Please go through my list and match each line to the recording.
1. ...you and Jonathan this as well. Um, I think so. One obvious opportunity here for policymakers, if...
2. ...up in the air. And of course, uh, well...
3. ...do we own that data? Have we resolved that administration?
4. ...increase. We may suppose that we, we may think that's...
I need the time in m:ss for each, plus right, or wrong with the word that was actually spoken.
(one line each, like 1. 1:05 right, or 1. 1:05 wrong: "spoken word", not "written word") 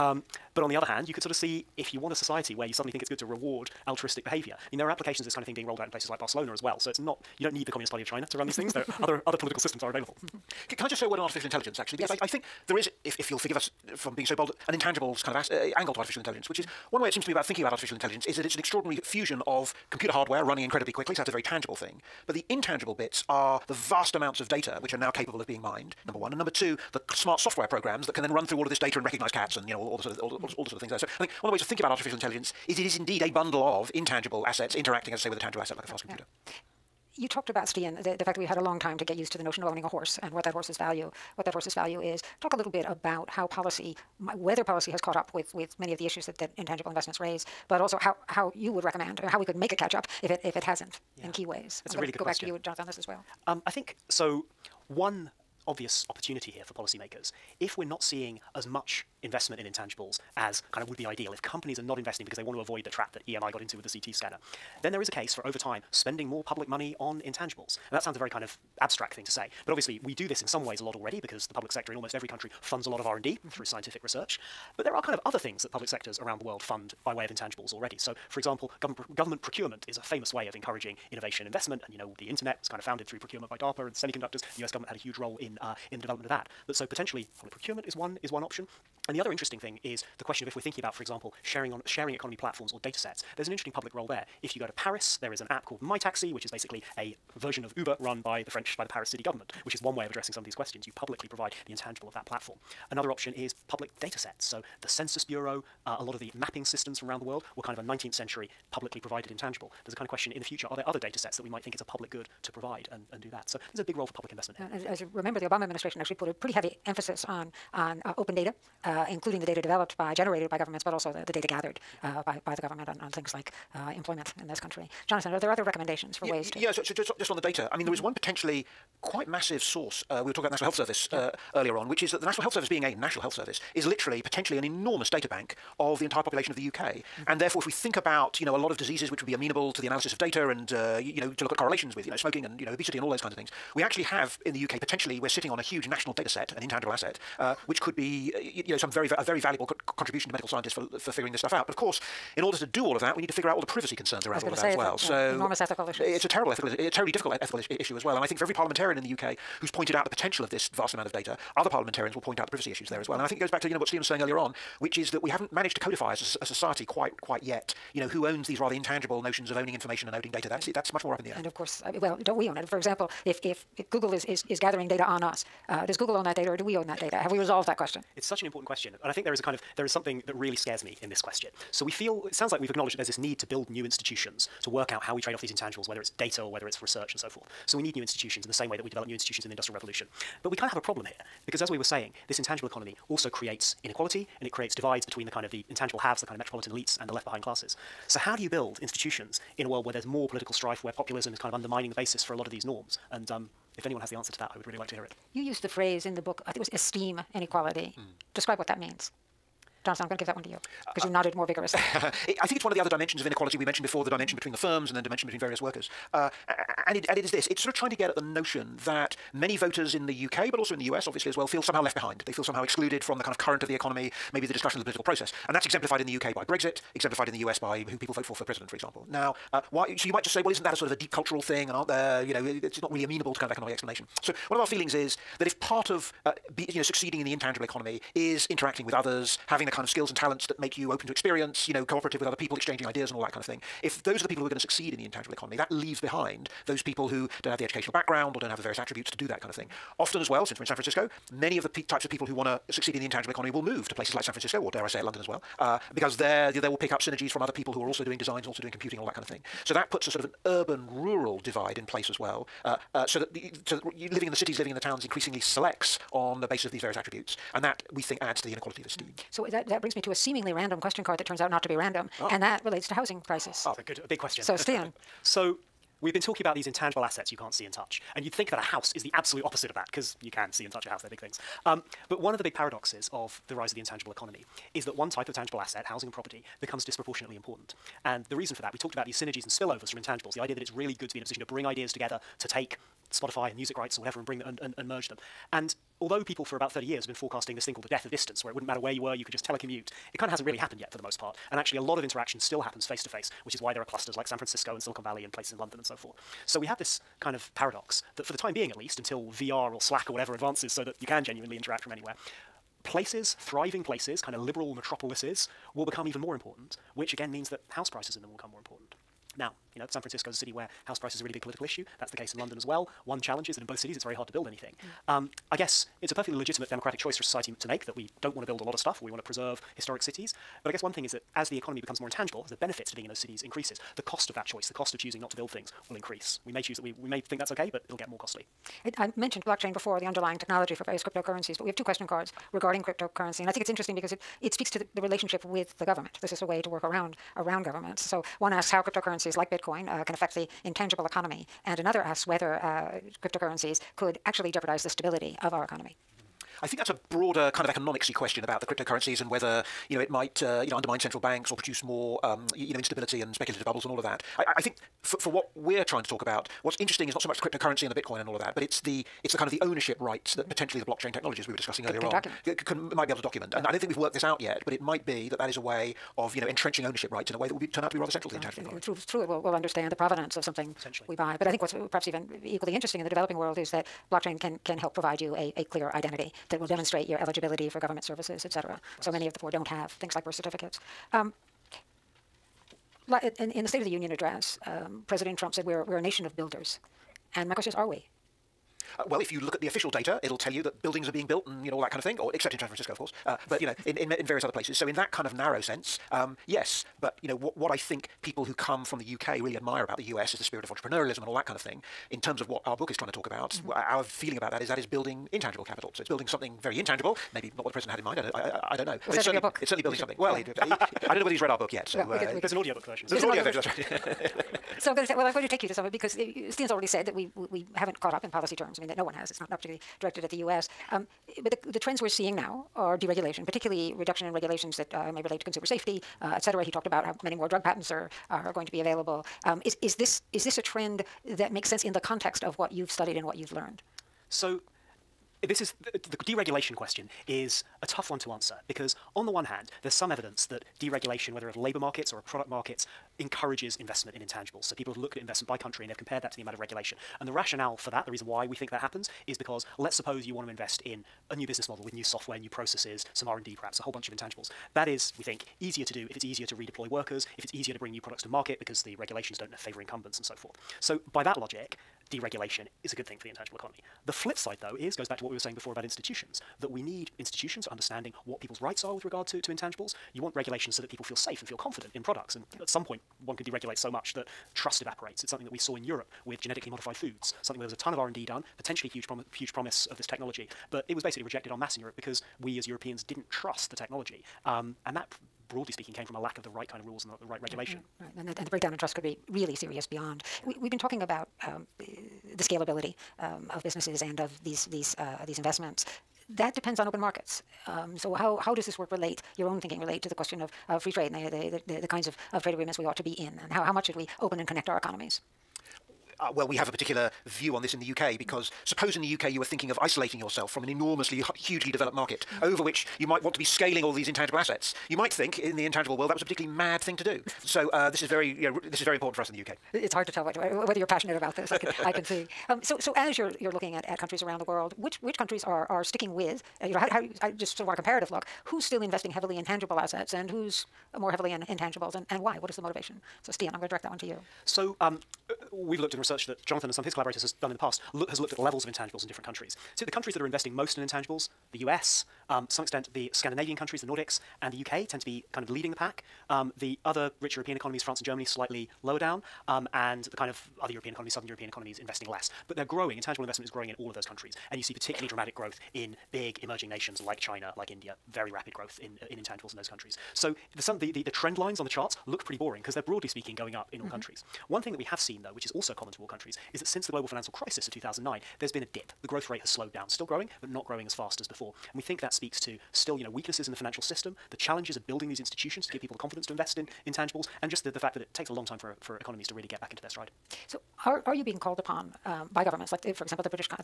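1. 0:52 right
2. 2:51 right
3. 2:56 wrong: "question", not "administration"
4. 5:35 wrong: "choose", not "suppose".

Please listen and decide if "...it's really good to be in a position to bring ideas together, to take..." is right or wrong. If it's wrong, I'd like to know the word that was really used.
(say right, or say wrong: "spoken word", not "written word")
right.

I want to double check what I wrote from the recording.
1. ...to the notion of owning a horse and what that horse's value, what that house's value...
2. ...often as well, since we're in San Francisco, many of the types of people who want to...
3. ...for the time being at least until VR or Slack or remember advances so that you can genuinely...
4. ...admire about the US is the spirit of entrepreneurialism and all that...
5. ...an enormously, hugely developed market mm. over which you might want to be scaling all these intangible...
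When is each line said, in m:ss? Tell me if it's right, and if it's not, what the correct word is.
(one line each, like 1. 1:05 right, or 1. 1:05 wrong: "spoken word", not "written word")
1. 0:39 wrong: "horse", not "house"
2. 4:09 right
3. 5:08 wrong: "whatever", not "remember"
4. 6:49 right
5. 8:40 right.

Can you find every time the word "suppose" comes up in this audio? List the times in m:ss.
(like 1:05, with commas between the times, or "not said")
7:39, 8:38.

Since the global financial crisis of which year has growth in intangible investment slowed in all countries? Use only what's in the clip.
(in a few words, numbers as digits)
2009.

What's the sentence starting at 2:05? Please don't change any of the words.
Jonathan, are there other recommendations for yeah, ways to?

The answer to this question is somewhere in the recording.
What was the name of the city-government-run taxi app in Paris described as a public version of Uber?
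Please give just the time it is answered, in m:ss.
1:35.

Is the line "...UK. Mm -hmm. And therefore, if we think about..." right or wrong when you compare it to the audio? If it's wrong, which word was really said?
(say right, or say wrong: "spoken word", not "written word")
right.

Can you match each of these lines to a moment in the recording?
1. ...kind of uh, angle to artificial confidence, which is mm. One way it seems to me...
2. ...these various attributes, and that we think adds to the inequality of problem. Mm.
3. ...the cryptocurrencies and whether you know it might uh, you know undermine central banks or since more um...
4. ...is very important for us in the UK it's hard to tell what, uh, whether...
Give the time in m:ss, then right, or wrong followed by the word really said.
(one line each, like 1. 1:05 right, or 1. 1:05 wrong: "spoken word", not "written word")
1. 0:15 wrong: "intelligence", not "confidence"
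2. 4:26 wrong: "esteem", not "problem"
3. 5:58 wrong: "produce", not "since"
4. 8:48 right.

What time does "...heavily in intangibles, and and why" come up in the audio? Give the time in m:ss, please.
9:01.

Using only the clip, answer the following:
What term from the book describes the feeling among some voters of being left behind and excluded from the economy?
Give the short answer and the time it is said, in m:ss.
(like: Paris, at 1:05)
esteem inequality, at 3:26.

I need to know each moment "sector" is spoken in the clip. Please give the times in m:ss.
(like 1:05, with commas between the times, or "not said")
1:11, 1:15.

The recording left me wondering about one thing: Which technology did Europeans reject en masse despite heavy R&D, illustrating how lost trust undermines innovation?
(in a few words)
genetically modified foods.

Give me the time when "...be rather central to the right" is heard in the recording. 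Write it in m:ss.
6:17.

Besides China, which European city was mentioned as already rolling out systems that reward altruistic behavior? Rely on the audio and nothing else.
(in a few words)
Barcelona.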